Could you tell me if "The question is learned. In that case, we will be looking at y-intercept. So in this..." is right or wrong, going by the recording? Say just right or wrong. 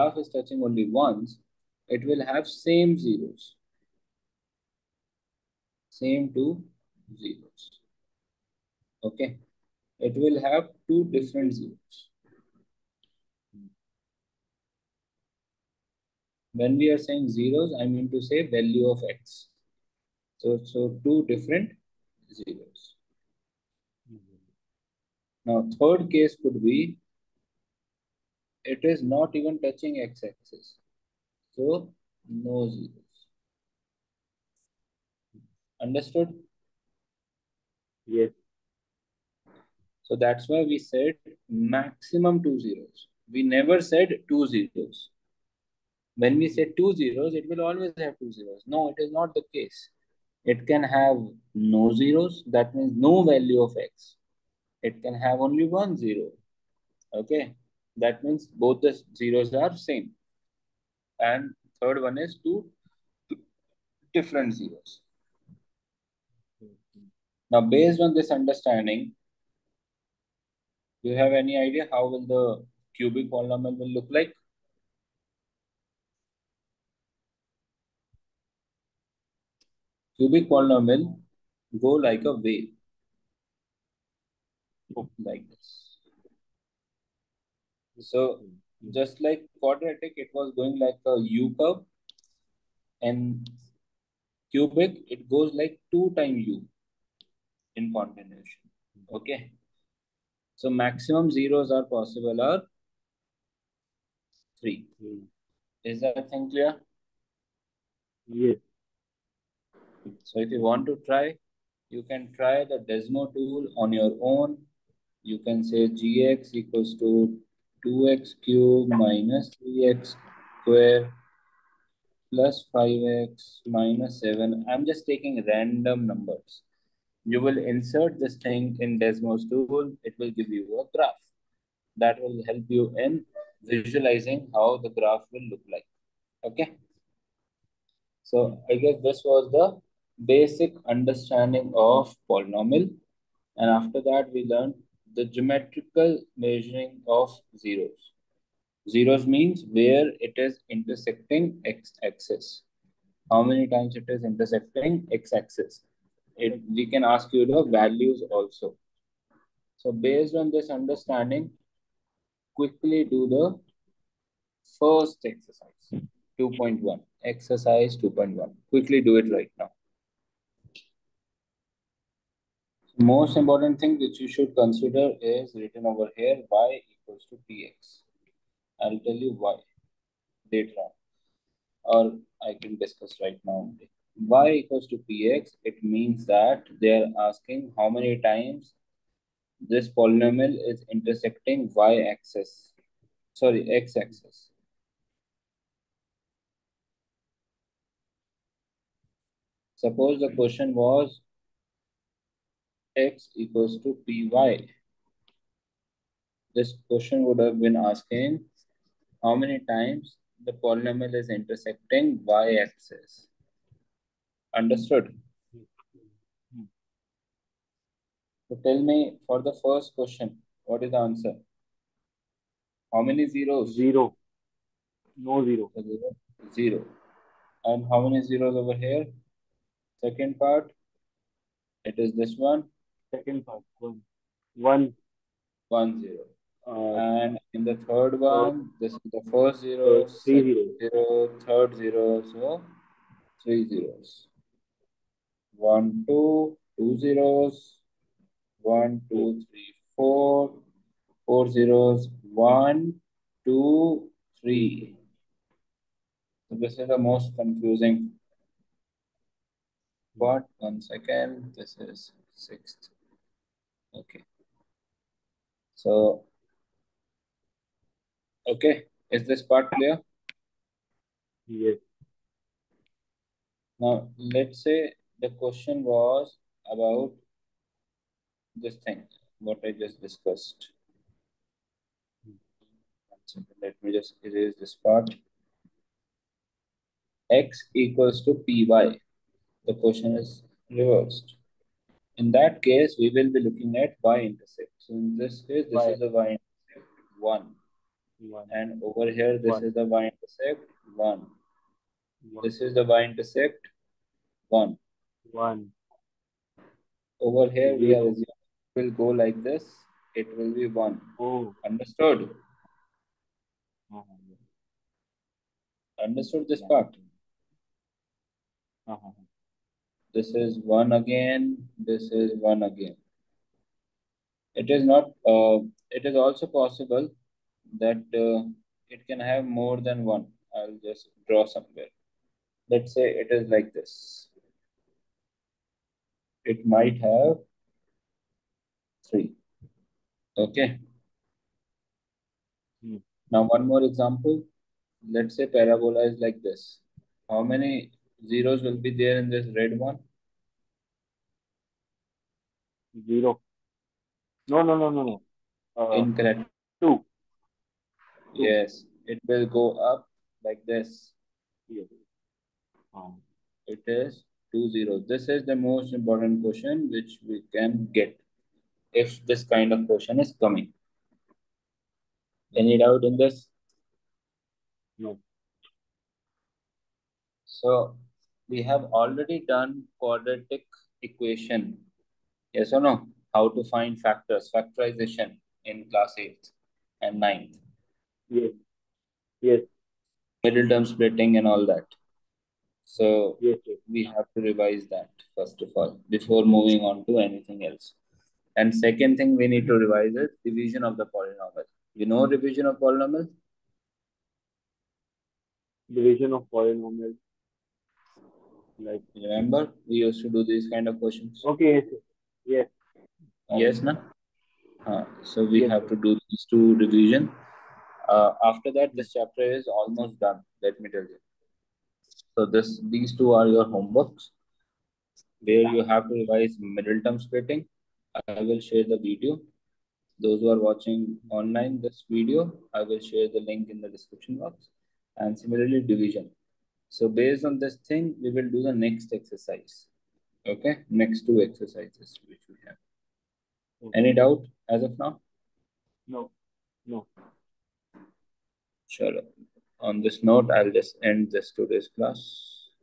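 wrong.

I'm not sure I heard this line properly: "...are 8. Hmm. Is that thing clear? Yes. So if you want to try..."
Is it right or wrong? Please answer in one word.
wrong.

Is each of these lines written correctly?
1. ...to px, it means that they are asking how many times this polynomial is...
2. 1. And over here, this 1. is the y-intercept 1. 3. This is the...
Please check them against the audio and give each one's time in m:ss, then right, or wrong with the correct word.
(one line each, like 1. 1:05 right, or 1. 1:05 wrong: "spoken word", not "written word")
1. 3:04 right
2. 4:58 wrong: "1", not "3".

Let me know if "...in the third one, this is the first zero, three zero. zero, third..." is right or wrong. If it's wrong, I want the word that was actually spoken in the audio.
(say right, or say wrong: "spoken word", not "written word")
right.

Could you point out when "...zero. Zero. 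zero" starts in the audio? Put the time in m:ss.
3:45.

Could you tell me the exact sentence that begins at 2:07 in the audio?
You will insert this thing in Desmos tool.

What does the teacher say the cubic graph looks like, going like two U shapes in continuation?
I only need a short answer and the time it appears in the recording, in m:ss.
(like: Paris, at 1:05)
A wave, at 1:22.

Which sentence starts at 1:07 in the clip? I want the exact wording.
Now, based on this understanding, do you have any idea how will the cubic polynomial will look like?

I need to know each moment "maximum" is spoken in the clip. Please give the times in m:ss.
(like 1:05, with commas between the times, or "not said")
0:41, 1:40.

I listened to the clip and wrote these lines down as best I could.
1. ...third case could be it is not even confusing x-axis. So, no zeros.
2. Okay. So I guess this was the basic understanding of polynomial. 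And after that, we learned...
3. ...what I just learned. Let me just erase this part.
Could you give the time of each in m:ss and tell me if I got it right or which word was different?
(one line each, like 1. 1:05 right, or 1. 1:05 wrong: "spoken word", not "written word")
1. 0:25 wrong: "touching", not "confusing"
2. 2:16 right
3. 4:39 wrong: "discussed", not "learned".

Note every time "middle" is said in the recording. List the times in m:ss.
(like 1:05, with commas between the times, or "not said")
6:30, 7:06.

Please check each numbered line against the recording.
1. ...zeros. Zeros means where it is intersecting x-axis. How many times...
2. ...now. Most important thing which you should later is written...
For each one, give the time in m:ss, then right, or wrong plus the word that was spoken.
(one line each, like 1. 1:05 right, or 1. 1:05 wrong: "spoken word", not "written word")
1. 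2:27 right
2. 2:49 wrong: "consider", not "later".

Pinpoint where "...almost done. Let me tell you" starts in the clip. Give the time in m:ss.
6:59.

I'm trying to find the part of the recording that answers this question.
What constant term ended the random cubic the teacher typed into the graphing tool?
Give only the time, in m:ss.
2:03.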